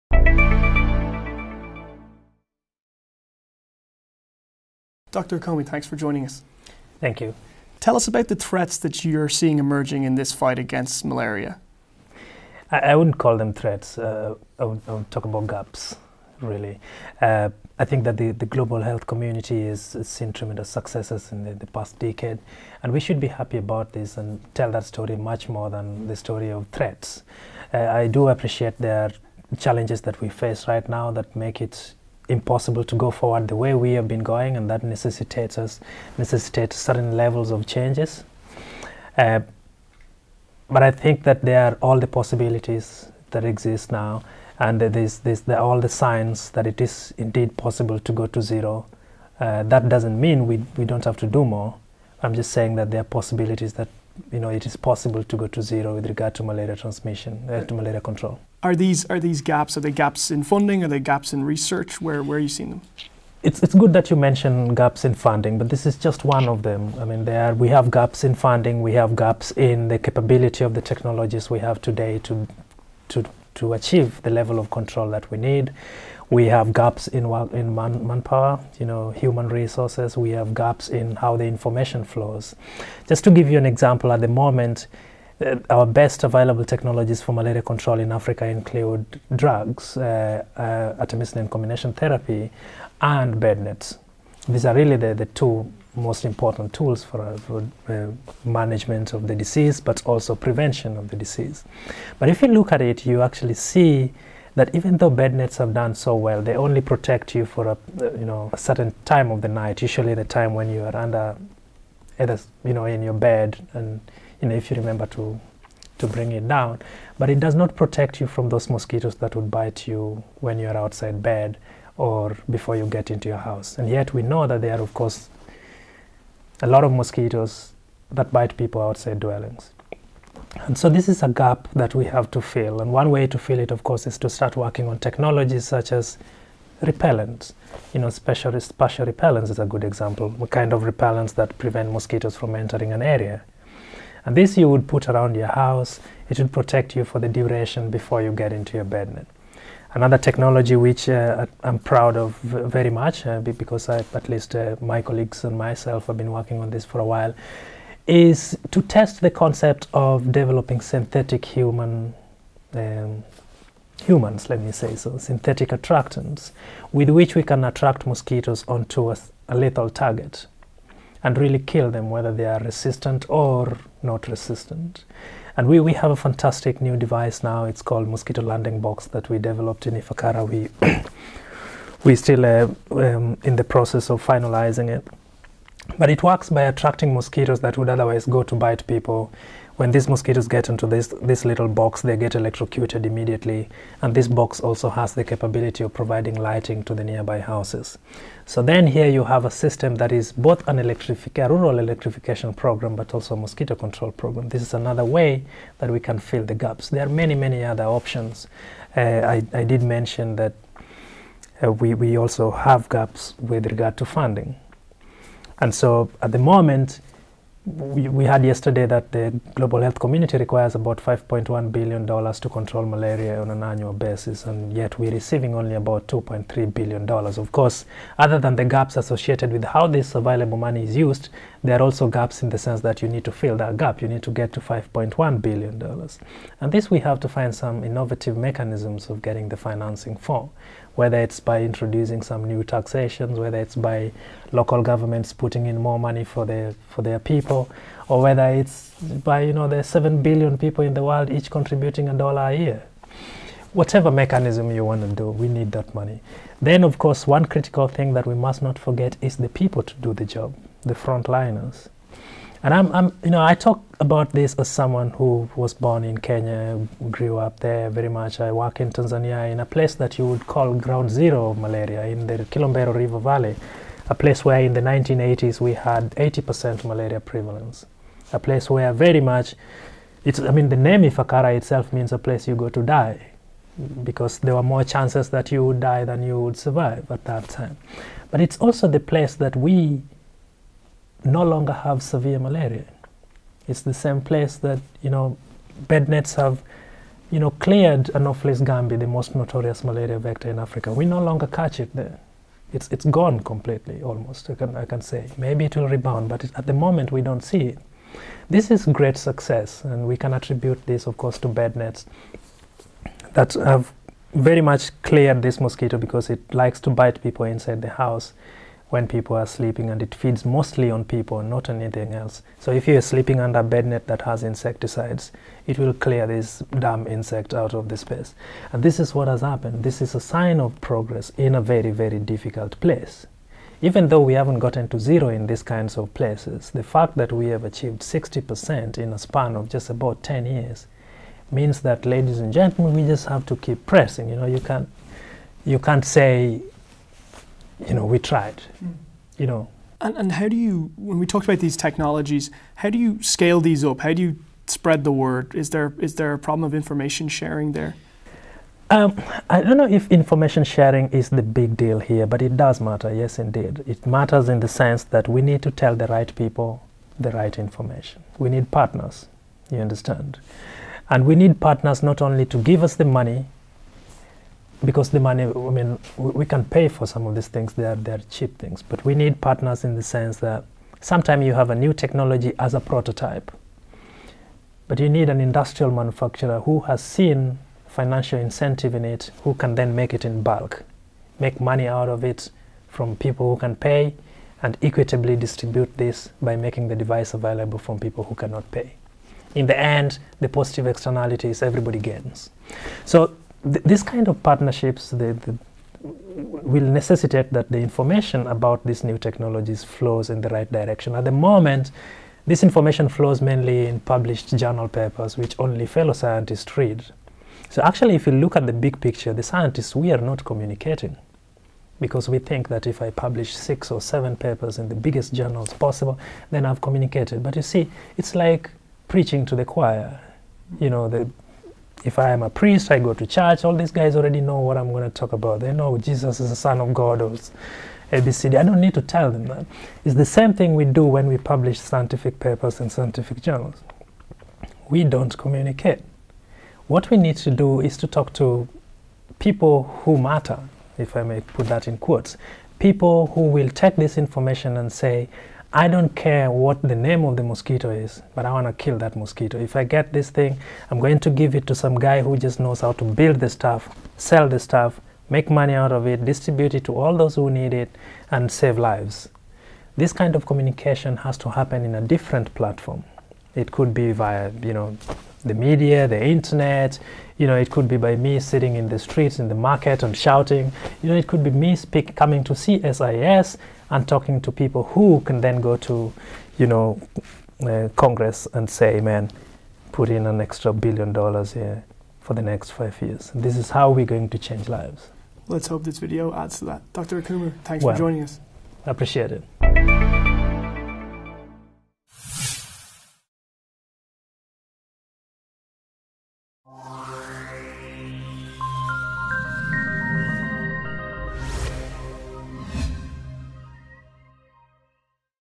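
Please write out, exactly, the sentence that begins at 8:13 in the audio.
This is how we're going to change lives.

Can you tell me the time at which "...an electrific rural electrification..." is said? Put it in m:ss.
3:20.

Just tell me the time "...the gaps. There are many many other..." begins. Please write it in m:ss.
3:26.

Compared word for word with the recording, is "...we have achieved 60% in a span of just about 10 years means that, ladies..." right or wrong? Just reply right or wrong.
right.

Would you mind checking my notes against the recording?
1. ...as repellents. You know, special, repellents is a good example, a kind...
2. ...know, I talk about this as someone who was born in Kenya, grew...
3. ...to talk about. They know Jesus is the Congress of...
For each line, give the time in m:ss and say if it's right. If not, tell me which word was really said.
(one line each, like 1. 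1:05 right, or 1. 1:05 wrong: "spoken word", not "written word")
1. 2:15 right
2. 4:23 right
3. 7:15 wrong: "Son", not "Congress".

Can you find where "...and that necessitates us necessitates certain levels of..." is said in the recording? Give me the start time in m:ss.
0:34.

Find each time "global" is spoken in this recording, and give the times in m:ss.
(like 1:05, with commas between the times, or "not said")
0:18, 3:39.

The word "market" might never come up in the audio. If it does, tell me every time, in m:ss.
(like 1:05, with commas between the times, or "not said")
7:59.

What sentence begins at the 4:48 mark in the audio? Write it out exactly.
But it's also the place that we no longer have severe malaria.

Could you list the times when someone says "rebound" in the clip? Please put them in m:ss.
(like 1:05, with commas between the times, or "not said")
5:05.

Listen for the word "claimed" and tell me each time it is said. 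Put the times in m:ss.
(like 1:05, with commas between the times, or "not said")
not said.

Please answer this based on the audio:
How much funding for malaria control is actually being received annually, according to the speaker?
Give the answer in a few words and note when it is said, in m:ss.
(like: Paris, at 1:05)
$2.3 billion, at 3:46.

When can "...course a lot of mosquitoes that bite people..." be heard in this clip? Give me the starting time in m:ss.
2:04.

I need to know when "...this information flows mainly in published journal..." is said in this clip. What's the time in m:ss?
6:52.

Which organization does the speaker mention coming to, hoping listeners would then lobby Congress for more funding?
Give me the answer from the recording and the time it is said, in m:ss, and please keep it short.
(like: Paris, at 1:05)
CSIS, at 8:02.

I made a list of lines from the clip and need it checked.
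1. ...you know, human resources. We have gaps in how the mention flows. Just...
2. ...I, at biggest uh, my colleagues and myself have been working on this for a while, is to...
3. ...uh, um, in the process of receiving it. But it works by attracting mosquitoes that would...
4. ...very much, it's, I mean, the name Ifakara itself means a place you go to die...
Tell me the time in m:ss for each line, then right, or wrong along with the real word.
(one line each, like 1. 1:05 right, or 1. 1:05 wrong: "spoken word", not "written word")
1. 1:18 wrong: "information", not "mention"
2. 2:33 wrong: "least", not "biggest"
3. 3:02 wrong: "finalizing", not "receiving"
4. 4:38 right.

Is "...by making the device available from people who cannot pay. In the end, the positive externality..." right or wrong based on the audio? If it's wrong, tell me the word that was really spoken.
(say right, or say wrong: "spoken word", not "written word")
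right.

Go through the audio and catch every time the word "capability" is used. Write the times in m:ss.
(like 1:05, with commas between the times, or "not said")
1:09, 3:15.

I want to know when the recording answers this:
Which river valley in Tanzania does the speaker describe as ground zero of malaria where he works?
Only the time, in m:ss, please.
4:32.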